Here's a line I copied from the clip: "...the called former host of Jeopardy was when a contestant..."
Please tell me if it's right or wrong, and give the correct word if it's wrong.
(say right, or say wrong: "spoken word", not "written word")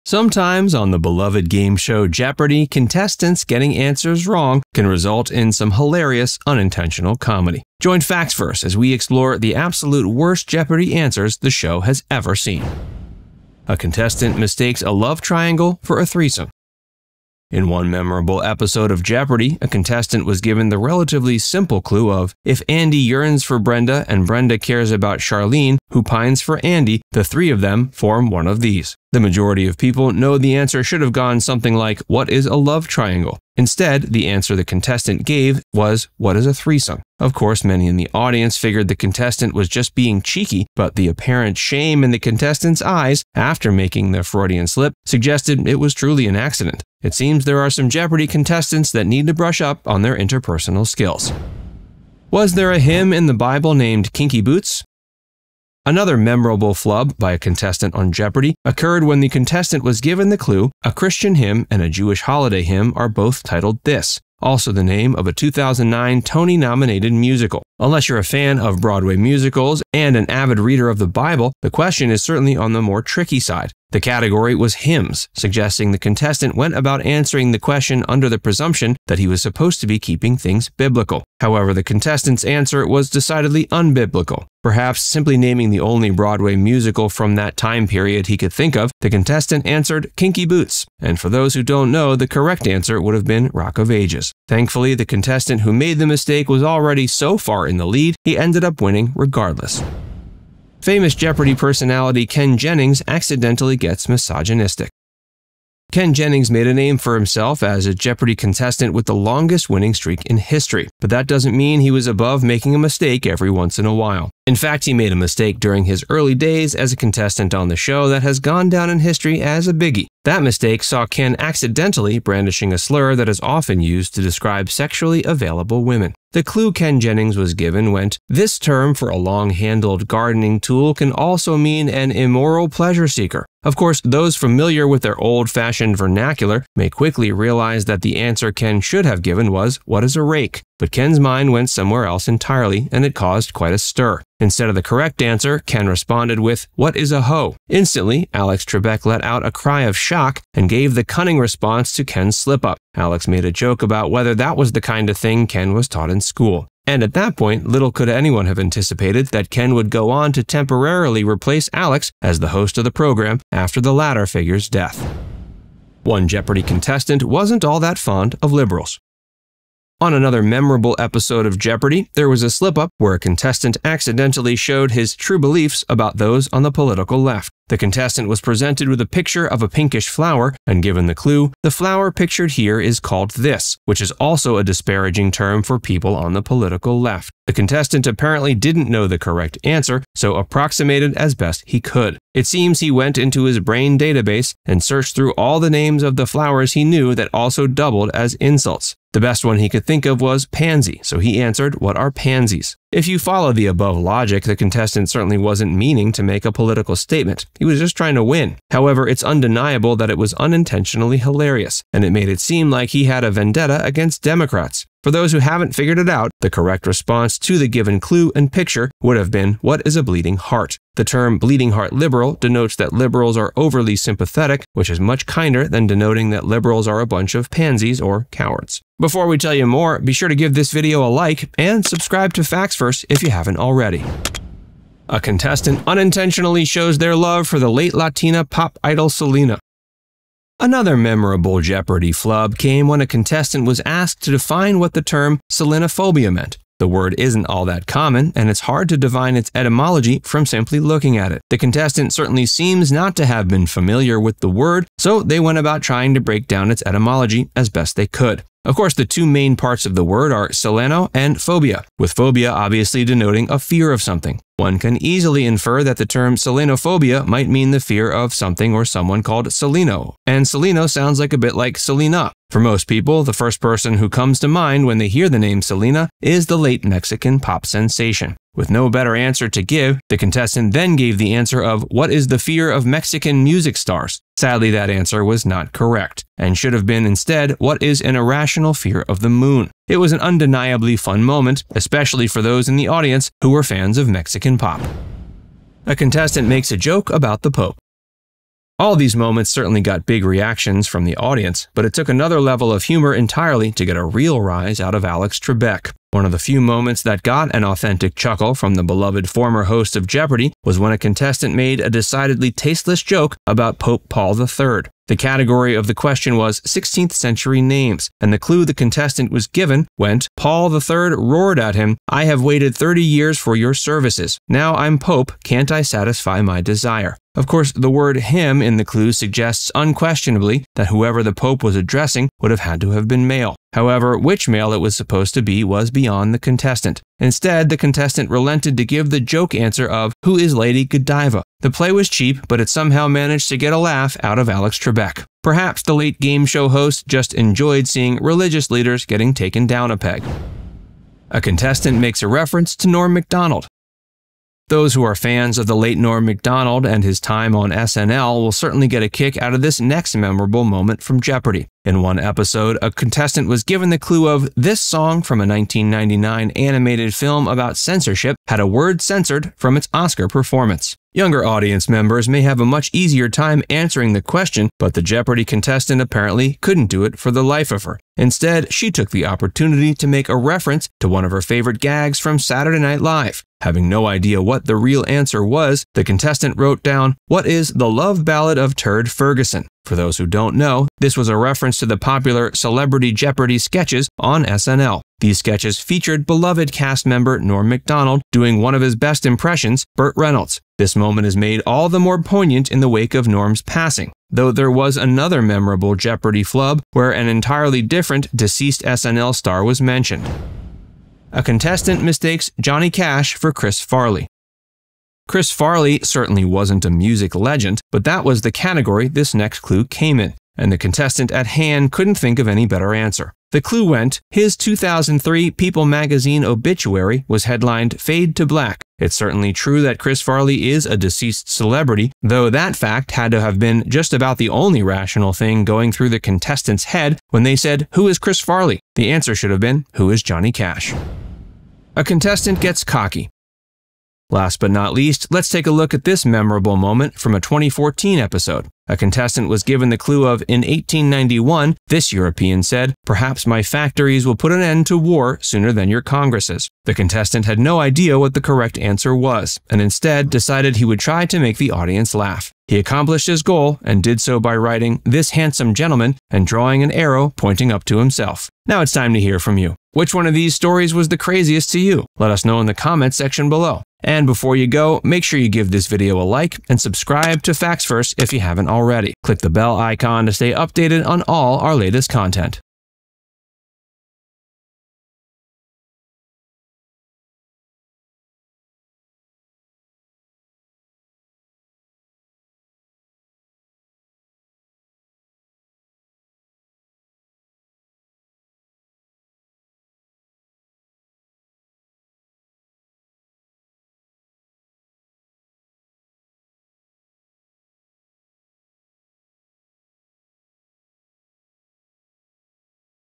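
wrong: "beloved", not "called".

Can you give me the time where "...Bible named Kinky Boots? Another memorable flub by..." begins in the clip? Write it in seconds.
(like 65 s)
53 s.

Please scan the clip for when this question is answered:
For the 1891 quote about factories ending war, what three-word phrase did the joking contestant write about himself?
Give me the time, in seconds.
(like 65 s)
465 s.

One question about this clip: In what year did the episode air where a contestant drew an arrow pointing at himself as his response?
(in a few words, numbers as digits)
2014.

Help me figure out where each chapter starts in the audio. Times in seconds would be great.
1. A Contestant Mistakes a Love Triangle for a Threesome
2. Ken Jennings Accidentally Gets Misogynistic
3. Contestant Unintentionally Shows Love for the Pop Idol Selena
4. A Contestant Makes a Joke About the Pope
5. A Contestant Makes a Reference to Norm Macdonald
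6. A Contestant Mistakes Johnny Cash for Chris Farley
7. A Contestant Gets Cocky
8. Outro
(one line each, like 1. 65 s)
1. 13 s
2. 100 s
3. 235 s
4. 296 s
5. 351 s
6. 411 s
7. 442 s
8. 468 s.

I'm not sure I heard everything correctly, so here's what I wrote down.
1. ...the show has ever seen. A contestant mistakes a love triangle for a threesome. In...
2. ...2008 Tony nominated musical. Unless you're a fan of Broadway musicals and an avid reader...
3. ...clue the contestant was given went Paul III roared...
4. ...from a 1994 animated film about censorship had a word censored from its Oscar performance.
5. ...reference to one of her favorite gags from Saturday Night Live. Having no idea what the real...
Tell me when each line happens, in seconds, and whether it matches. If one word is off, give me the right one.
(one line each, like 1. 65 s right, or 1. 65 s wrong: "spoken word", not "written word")
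1. 11 s right
2. 65 s wrong: "2009", not "2008"
3. 318 s right
4. 365 s wrong: "1999", not "1994"
5. 380 s right.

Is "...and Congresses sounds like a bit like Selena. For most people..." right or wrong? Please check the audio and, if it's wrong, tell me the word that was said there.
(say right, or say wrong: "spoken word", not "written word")
wrong: "Seleno", not "Congresses".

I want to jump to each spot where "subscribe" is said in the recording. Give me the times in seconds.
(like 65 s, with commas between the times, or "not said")
231 s, 476 s.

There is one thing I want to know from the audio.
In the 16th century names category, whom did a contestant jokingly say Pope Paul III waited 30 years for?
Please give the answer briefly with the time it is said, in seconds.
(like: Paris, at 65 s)
Lady Godiva, at 340 s.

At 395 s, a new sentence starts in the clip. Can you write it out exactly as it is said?
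These sketches featured beloved cast member Norm Macdonald doing one of his best impressions, Burt Reynolds.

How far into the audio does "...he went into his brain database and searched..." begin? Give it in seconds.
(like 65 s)
192 s.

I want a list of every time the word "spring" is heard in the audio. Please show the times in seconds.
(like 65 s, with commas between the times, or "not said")
not said.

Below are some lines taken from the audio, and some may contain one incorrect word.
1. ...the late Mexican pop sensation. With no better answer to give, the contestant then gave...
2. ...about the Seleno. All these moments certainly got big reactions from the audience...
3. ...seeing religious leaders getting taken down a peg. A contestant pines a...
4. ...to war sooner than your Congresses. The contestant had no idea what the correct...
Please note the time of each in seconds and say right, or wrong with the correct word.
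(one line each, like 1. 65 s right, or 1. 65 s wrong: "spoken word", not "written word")
1. 276 s right
2. 297 s wrong: "Pope", not "Seleno"
3. 347 s wrong: "makes", not "pines"
4. 454 s right.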